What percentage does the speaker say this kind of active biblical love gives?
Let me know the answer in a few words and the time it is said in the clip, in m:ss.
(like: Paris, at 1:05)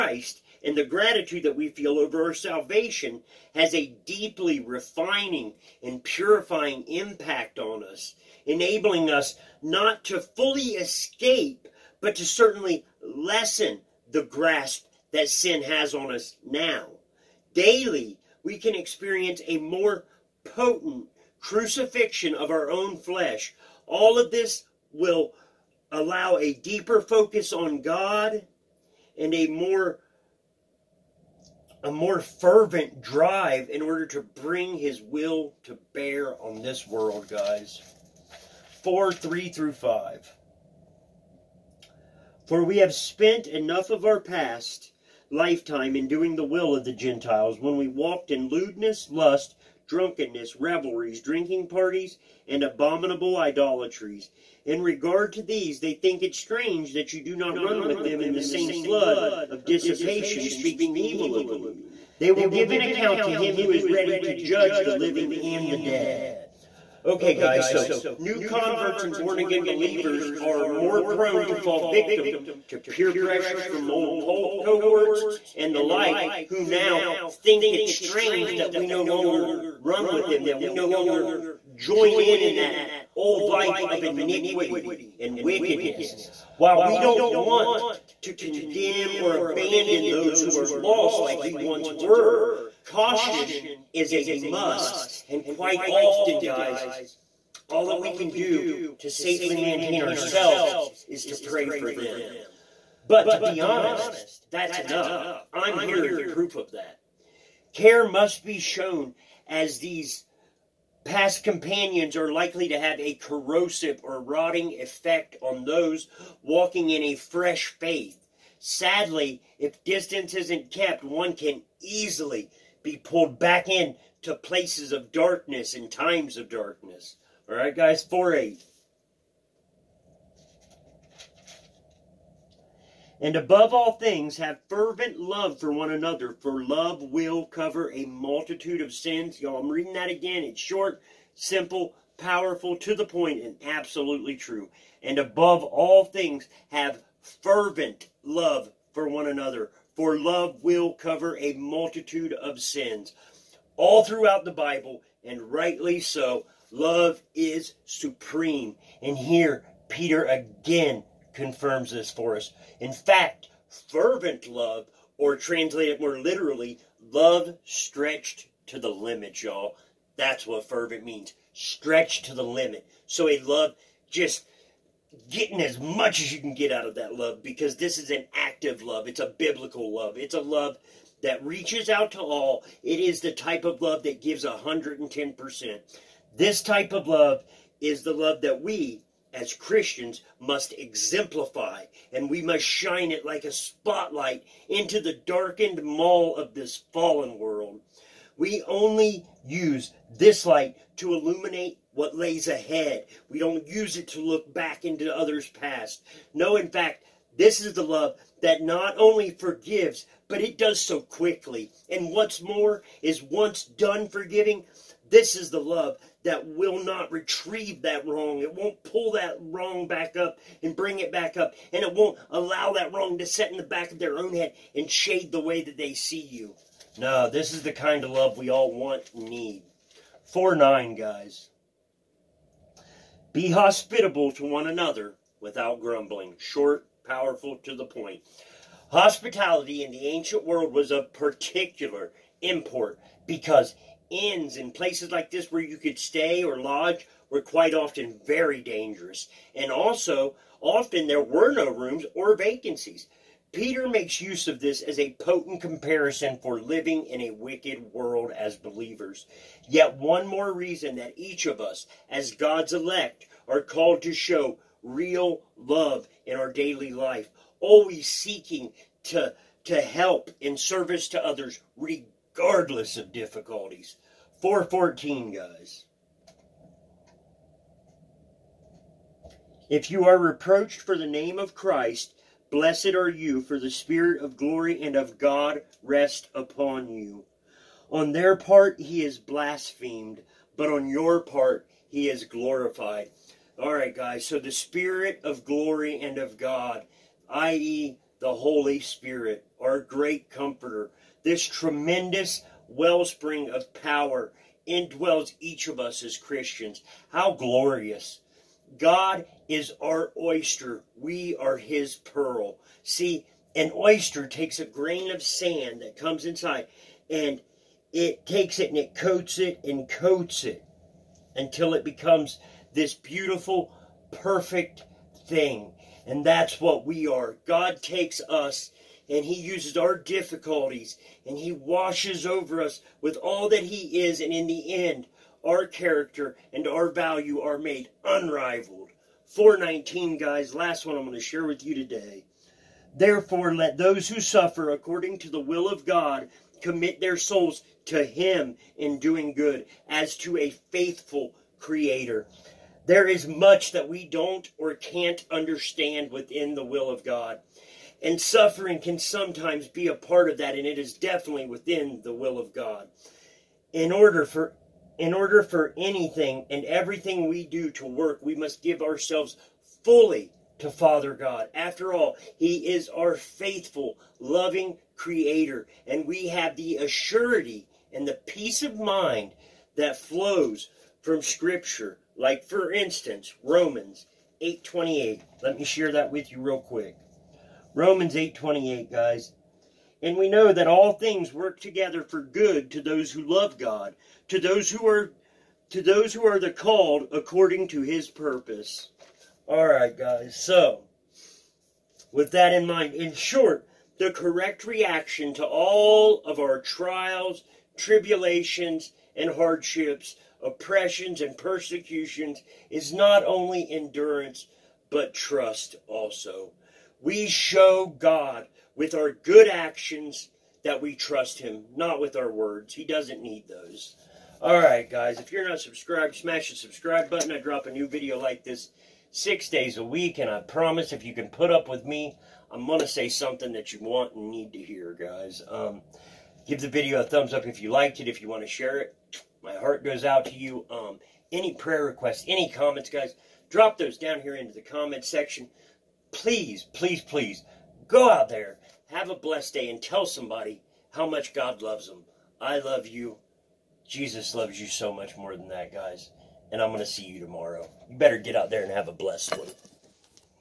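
110%, at 3:04.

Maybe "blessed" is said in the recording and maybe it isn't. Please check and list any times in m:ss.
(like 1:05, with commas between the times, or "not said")
4:42, 7:29, 7:38.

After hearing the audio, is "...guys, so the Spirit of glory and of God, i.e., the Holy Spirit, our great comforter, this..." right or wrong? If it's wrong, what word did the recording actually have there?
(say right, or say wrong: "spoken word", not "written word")
right.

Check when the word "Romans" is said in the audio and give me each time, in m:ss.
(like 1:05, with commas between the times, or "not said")
6:23, 6:27.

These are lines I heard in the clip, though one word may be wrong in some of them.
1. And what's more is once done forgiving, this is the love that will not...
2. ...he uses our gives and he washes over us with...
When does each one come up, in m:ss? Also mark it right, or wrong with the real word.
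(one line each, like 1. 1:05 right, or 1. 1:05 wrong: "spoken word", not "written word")
1. 3:31 right
2. 5:29 wrong: "difficulties", not "gives".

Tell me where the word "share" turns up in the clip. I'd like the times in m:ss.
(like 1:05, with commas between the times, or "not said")
5:41, 6:25, 7:18.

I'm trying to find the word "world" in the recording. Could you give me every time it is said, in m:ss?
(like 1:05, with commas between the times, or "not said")
0:36, 3:17, 4:00, 4:17.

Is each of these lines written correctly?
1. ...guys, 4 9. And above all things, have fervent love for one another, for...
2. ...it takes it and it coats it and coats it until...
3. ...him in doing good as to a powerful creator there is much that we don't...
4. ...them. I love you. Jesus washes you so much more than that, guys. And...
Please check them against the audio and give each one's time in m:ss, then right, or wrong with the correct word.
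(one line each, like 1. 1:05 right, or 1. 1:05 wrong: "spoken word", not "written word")
1. 2:07 wrong: "8", not "9"
2. 5:17 right
3. 5:48 wrong: "faithful", not "powerful"
4. 7:31 wrong: "loves", not "washes".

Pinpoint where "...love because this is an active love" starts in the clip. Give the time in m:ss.
2:57.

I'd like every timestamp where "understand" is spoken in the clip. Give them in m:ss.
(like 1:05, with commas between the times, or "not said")
5:55.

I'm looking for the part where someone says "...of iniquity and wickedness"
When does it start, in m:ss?
1:23.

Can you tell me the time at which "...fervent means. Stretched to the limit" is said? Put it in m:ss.
2:50.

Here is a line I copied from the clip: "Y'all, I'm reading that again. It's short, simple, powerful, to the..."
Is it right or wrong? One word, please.
right.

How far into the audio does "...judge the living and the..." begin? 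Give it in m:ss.
1:04.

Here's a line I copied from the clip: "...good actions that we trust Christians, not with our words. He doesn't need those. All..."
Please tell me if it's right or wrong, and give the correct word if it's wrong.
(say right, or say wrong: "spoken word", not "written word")
wrong: "Him", not "Christians".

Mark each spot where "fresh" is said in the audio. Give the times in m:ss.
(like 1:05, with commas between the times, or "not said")
1:57.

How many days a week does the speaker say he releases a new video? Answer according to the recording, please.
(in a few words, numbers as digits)
6.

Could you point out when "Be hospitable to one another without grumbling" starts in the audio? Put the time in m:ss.
3:53.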